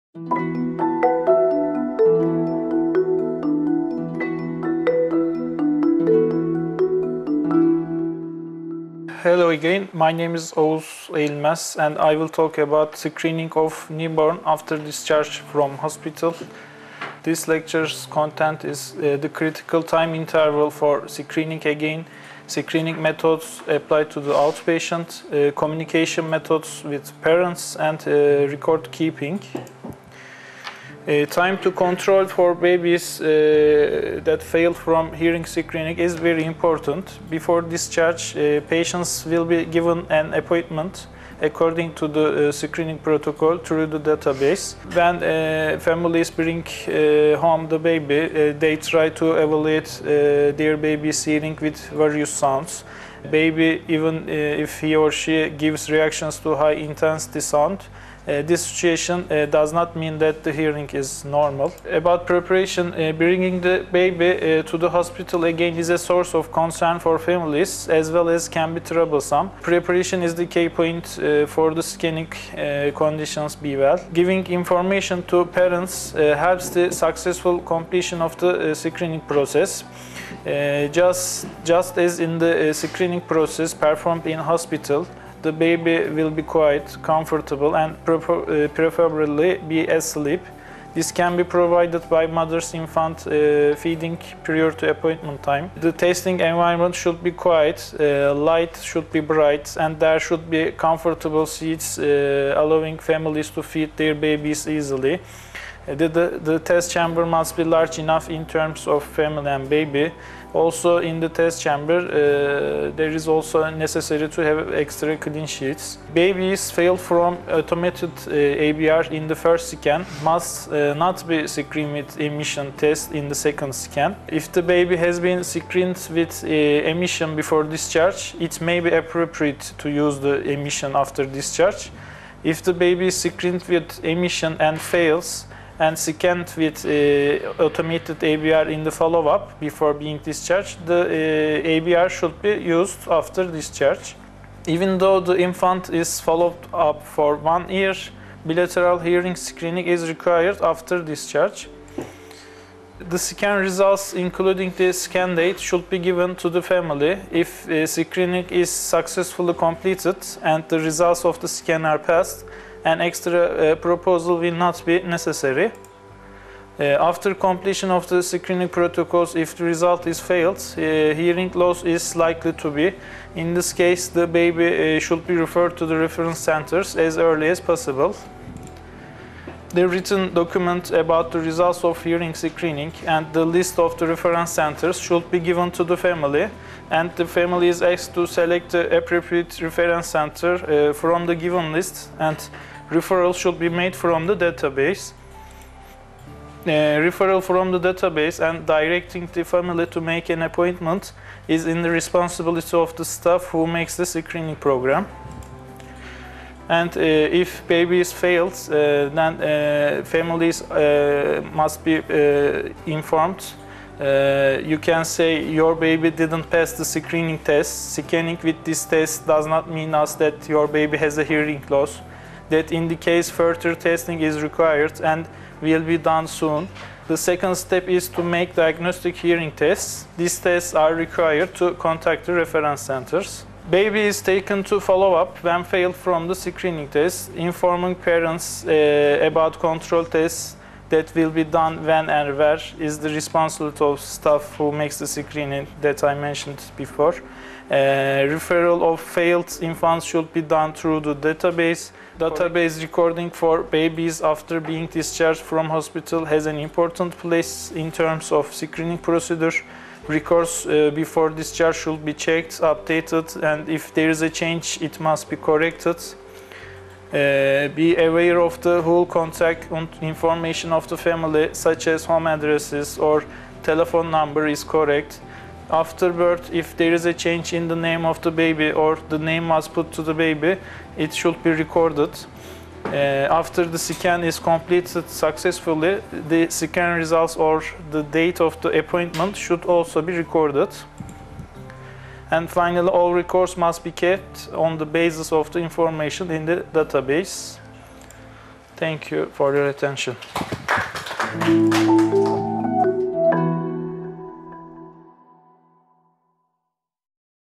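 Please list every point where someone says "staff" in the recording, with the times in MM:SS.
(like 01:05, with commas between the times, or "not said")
03:23, 04:04.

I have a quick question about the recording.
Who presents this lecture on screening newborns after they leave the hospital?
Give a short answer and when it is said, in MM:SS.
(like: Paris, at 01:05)
Oğuz Eğilmez, at 00:10.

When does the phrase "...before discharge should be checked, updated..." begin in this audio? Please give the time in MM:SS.
04:20.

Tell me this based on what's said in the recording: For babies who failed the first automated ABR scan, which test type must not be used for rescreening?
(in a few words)
Emission test.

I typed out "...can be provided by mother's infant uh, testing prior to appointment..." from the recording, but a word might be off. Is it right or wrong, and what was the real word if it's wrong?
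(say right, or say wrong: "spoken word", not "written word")
wrong: "feeding", not "testing".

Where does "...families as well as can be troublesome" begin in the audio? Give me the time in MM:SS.
01:07.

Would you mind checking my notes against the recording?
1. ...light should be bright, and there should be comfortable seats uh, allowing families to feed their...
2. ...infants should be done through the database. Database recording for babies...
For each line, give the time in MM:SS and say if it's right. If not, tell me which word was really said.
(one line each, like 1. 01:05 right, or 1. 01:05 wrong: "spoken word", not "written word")
1. 01:38 right
2. 04:09 right.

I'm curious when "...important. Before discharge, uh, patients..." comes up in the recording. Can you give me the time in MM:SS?
00:36.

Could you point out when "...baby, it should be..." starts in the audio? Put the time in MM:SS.
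04:40.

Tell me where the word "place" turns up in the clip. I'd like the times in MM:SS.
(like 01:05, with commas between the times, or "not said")
04:17.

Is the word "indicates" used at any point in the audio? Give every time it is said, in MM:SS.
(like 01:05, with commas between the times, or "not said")
03:42.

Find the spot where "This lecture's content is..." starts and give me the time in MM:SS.
00:17.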